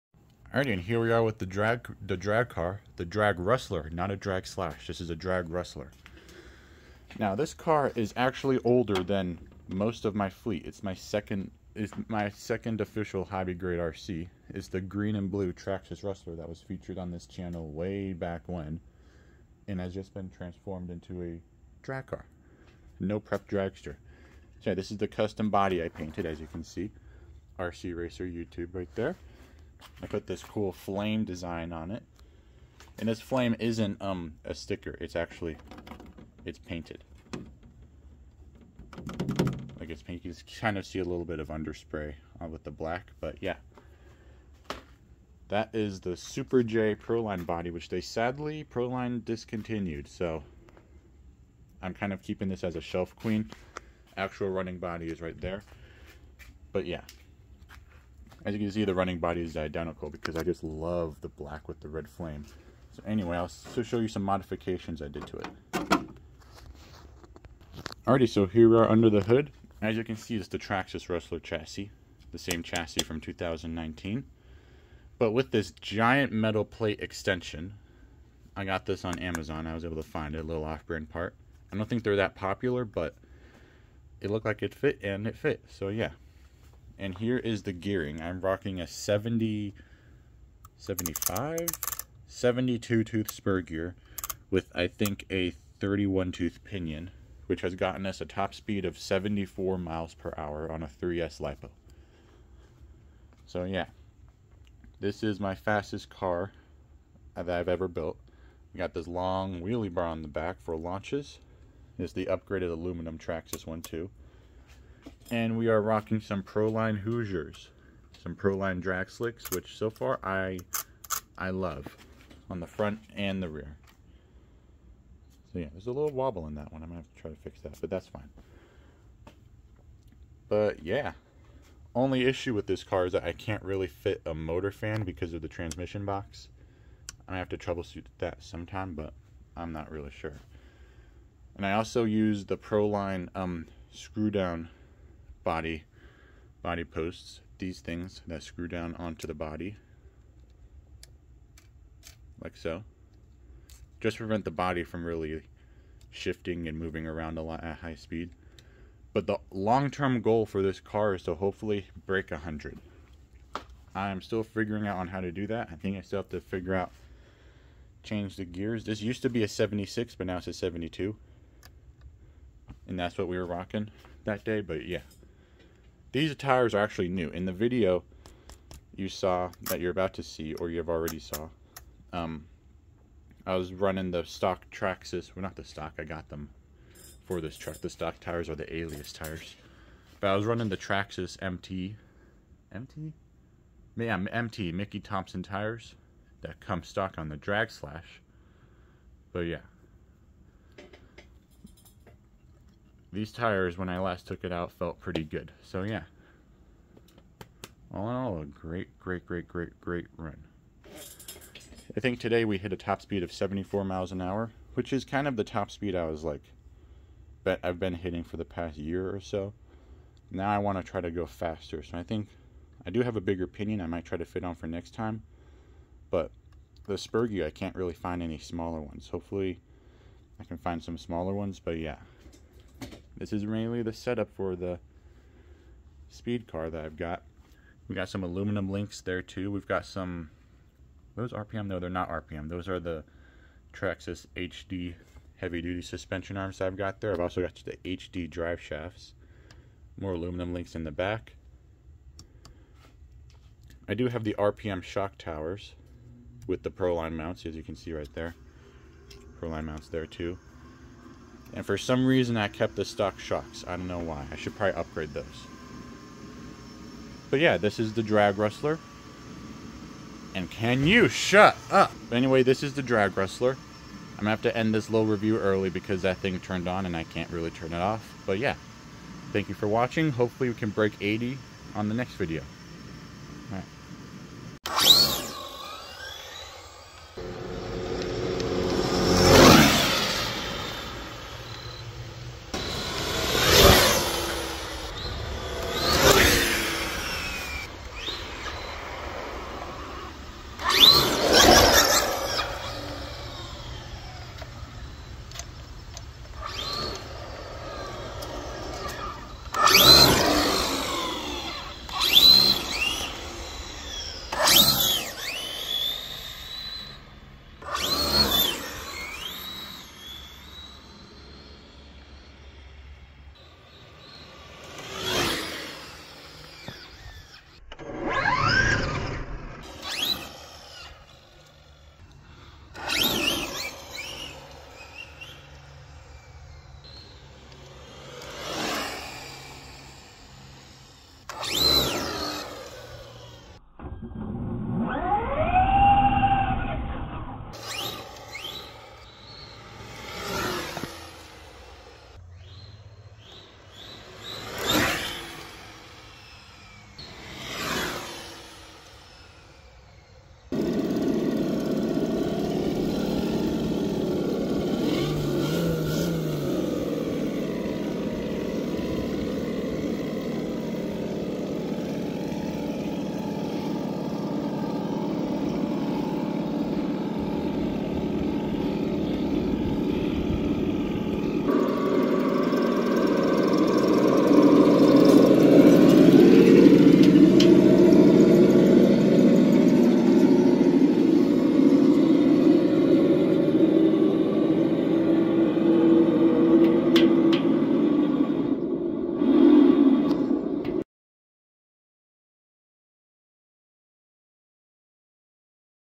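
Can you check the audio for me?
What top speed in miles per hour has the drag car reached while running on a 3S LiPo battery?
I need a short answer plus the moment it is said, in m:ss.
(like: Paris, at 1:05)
74, at 1:38.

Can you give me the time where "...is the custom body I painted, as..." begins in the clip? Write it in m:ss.
0:24.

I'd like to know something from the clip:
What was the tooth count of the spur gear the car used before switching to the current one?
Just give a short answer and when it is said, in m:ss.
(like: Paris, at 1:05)
76, at 2:49.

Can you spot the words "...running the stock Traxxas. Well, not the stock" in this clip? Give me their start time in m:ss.
3:03.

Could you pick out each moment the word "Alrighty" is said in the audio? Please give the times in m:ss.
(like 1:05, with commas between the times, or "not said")
0:00, 1:08.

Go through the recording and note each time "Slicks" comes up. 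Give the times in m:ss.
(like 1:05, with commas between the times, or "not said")
1:59.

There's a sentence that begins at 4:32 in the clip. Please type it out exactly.
But anyway, this is the Drag Rustler.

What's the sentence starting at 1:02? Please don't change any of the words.
So anyway, I'll show you some modifications I did to it.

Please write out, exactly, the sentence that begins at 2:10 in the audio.
But yeah, only issue with this car is that I can't really fit a motor fan because of the transmission box.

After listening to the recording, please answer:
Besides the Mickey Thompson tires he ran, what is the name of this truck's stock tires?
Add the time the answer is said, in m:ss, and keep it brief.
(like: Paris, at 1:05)
Alias, at 3:08.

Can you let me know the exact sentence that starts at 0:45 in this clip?
That is the Super J Proline body, which they sadly, Proline discontinued.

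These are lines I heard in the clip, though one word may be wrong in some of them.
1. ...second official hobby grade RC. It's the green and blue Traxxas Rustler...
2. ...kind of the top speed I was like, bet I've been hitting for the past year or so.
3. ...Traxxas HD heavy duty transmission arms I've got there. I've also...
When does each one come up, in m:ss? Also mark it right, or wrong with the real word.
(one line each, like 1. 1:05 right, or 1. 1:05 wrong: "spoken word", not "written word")
1. 0:12 right
2. 3:35 right
3. 4:03 wrong: "suspension", not "transmission".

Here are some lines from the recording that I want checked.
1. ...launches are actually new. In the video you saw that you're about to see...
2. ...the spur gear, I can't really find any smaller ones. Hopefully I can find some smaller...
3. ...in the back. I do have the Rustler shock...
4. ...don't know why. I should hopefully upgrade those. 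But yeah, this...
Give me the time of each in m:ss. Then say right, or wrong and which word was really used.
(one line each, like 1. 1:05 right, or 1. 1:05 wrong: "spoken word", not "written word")
1. 2:56 wrong: "tires", not "launches"
2. 3:46 right
3. 4:10 wrong: "RPM", not "Rustler"
4. 4:23 wrong: "probably", not "hopefully".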